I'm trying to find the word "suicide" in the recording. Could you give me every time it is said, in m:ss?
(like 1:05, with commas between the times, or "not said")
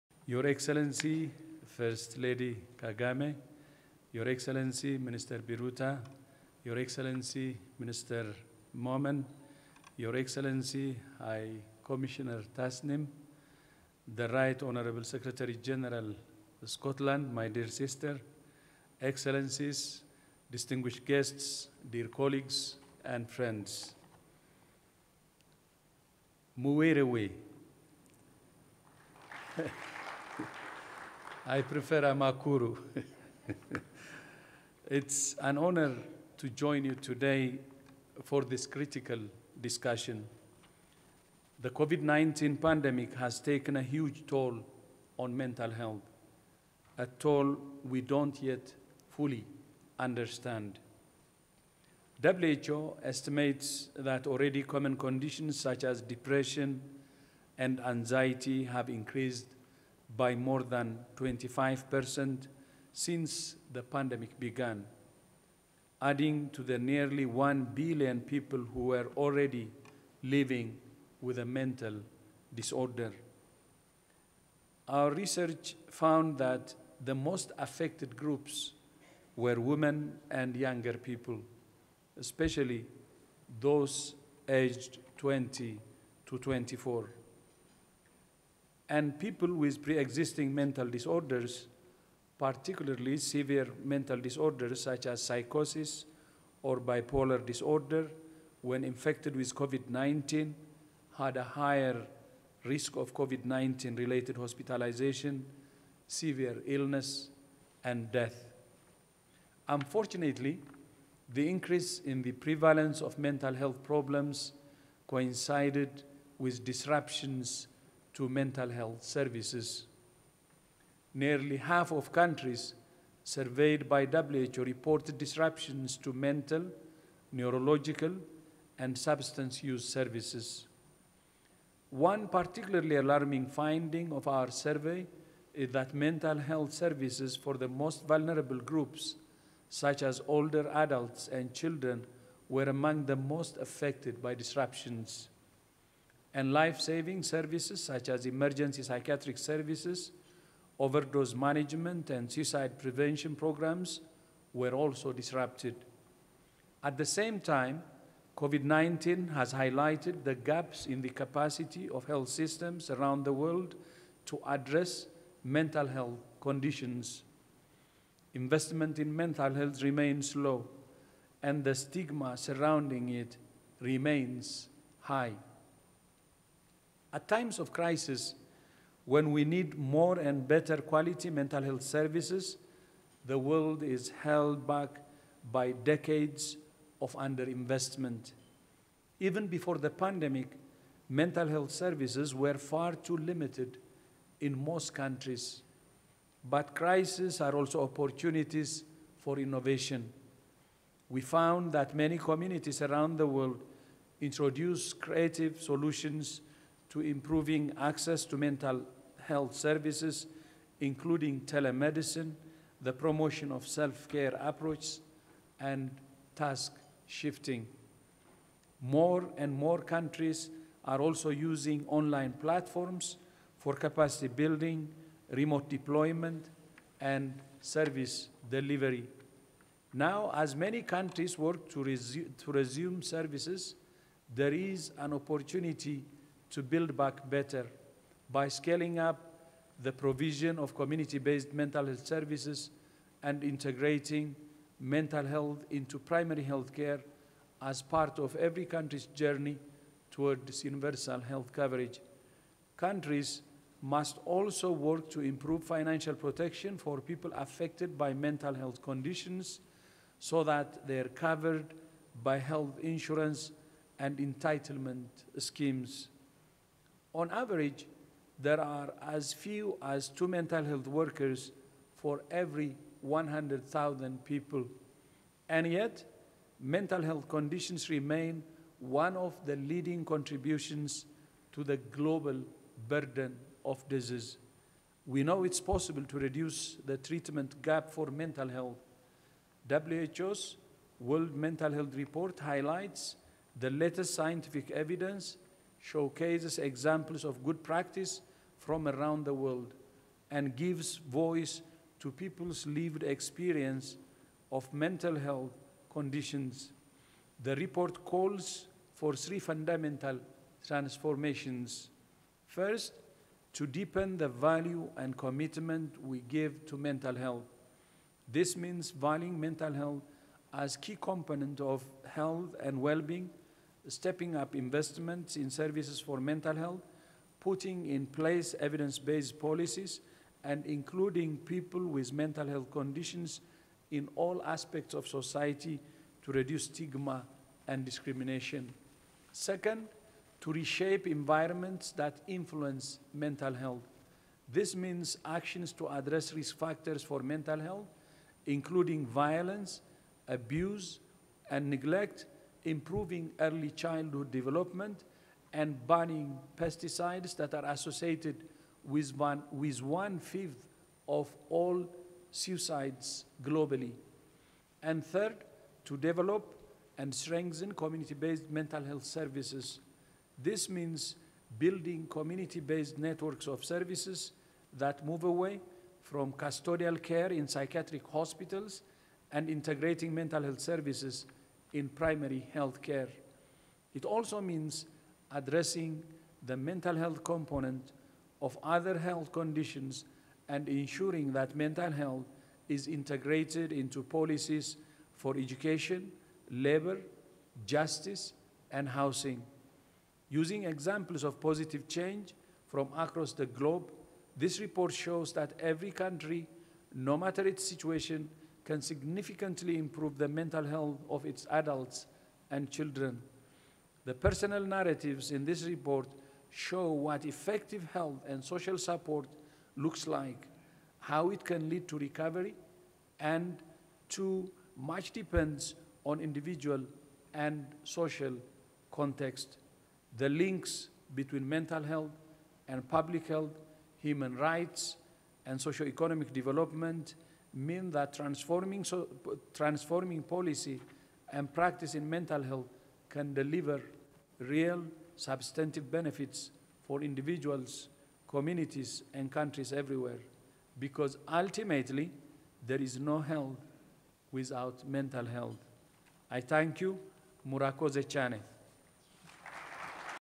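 2:32, 6:02.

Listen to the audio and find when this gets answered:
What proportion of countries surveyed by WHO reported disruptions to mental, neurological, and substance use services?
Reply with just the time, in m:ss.
2:01.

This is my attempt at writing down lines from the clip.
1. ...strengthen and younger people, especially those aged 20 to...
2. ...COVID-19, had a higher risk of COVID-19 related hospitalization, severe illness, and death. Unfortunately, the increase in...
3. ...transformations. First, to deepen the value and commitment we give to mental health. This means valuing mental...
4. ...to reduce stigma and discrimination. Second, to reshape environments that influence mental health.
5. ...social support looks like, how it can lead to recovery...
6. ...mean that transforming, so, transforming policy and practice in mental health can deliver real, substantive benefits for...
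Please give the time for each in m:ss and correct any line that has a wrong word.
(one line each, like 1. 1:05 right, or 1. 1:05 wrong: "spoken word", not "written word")
1. 1:19 wrong: "women", not "strengthen"
2. 1:39 right
3. 5:10 right
4. 5:36 right
5. 6:58 right
6. 7:17 right.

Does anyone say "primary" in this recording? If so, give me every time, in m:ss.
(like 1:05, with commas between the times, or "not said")
4:05, 6:21.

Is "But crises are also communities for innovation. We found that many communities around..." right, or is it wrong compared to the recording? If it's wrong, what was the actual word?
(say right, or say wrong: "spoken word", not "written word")
wrong: "opportunities", not "communities".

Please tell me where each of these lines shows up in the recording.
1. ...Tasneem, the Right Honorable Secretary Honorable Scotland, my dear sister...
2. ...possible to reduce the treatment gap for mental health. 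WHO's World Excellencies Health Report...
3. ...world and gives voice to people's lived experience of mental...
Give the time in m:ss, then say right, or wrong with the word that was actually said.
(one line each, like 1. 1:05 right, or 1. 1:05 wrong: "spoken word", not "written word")
1. 0:12 wrong: "General", not "Honorable"
2. 4:45 wrong: "Mental", not "Excellencies"
3. 4:59 right.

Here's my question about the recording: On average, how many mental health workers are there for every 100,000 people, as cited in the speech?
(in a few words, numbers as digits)
2.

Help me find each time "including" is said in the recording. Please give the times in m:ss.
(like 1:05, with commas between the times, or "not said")
3:30, 5:30, 5:48.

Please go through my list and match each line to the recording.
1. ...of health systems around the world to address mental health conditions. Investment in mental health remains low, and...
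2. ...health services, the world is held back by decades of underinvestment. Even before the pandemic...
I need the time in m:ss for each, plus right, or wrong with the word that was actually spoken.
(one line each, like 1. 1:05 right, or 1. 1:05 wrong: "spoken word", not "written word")
1. 2:41 right
2. 3:01 right.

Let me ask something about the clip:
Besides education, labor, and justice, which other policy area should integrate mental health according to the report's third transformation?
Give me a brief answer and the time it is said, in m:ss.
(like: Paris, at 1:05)
housing, at 6:38.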